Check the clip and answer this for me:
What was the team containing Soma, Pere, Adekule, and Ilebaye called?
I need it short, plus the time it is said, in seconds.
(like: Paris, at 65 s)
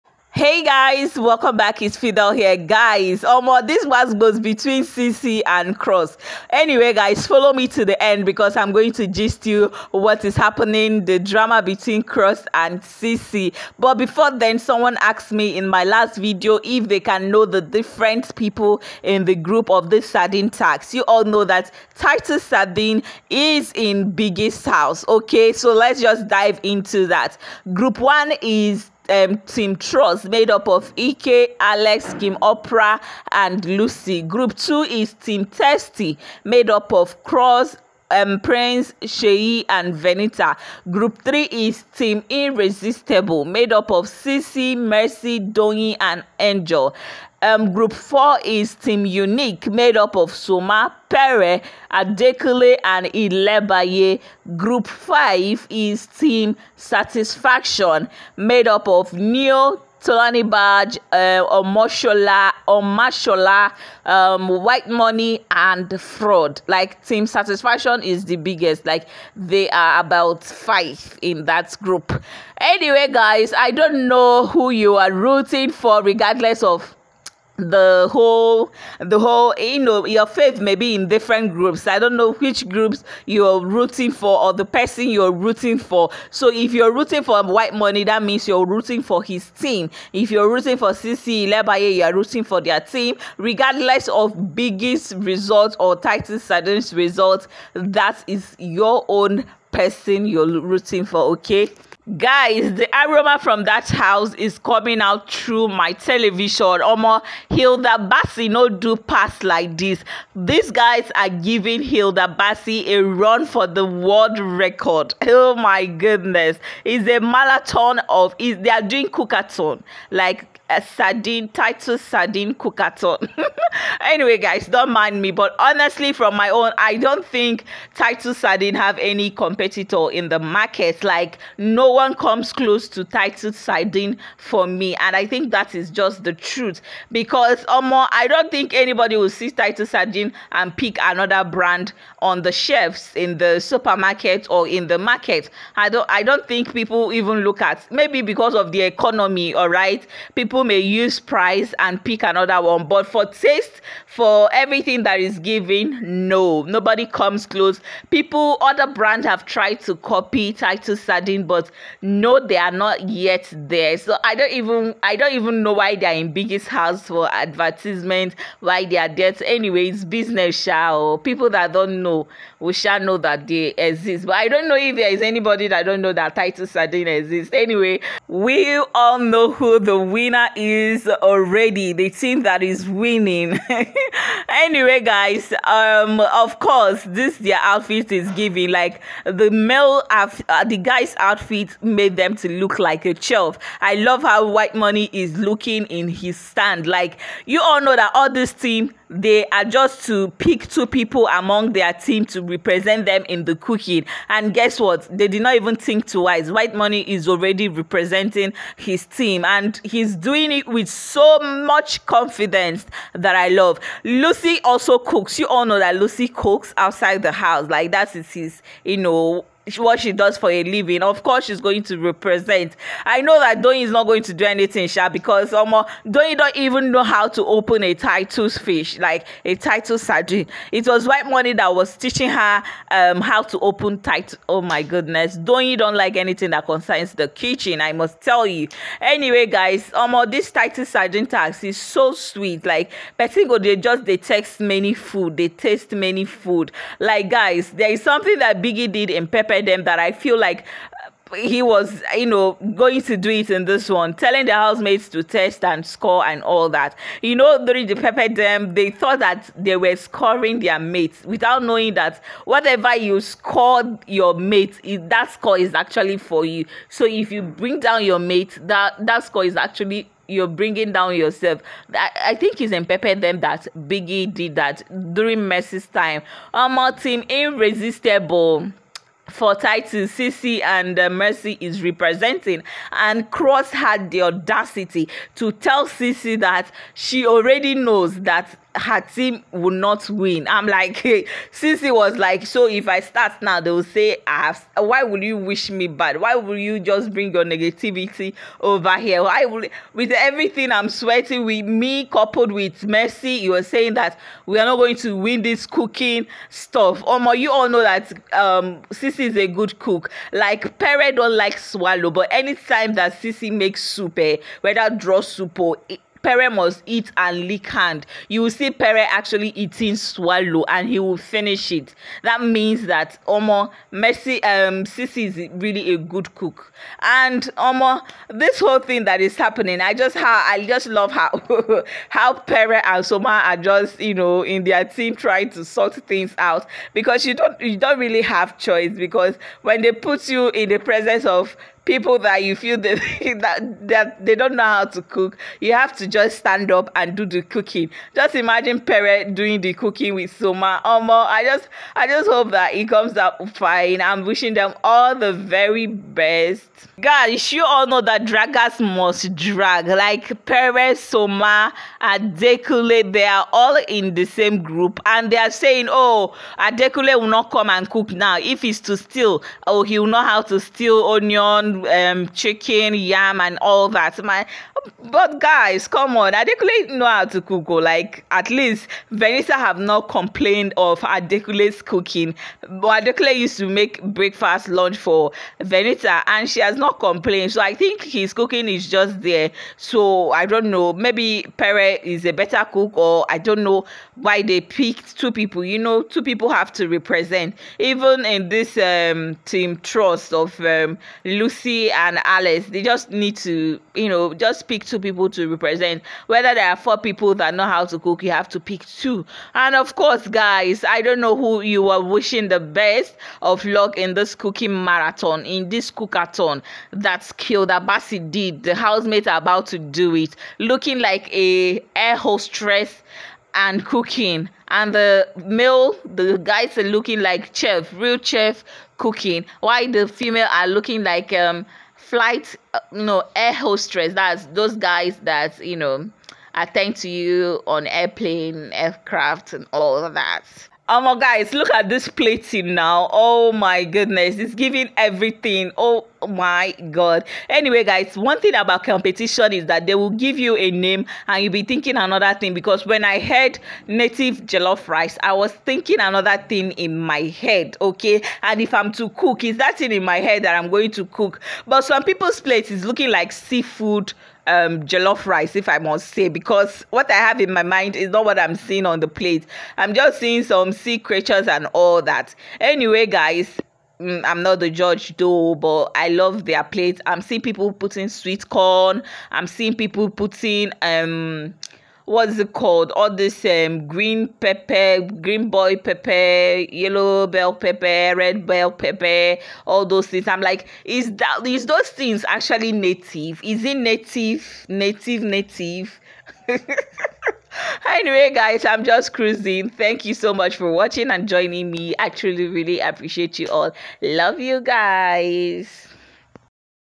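Team Unique, at 48 s.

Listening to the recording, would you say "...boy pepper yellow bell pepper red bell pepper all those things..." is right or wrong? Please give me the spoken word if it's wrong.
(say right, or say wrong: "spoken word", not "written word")
right.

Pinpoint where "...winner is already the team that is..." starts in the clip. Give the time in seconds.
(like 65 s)
179 s.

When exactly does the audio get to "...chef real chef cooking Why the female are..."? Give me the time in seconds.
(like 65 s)
427 s.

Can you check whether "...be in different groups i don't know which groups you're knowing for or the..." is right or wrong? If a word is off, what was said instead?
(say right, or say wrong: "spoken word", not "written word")
wrong: "rooting", not "knowing".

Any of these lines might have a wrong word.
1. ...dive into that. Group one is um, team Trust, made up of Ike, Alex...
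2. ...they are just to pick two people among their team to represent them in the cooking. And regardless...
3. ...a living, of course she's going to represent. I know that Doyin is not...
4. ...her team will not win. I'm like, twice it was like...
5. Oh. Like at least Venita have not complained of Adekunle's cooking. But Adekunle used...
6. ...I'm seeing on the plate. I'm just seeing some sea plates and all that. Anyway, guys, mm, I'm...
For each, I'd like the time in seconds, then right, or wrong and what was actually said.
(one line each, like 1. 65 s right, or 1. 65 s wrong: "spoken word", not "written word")
1. 26 s right
2. 199 s wrong: "guess", not "regardless"
3. 220 s right
4. 288 s wrong: "since", not "twice"
5. 377 s right
6. 468 s wrong: "creatures", not "plates".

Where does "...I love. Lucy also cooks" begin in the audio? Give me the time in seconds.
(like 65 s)
213 s.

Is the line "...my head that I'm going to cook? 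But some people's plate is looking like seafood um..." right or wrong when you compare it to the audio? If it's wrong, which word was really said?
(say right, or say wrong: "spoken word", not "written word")
right.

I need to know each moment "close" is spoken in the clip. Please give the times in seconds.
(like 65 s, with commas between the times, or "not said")
132 s, 157 s.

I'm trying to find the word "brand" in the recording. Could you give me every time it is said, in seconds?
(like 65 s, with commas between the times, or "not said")
141 s, 158 s.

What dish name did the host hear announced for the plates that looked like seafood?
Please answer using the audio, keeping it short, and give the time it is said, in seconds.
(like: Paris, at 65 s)
native jollof rice, at 453 s.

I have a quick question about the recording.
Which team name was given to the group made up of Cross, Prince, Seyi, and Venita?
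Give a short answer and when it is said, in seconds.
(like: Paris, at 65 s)
Team Testy, at 35 s.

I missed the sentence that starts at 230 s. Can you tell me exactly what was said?
It was white money that was teaching her um how to open Titus.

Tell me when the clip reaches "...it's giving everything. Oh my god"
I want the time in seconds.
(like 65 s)
444 s.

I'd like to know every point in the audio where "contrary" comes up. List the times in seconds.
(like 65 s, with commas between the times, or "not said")
not said.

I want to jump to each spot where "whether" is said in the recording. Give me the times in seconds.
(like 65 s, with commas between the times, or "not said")
314 s, 406 s.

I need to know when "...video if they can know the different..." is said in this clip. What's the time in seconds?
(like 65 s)
16 s.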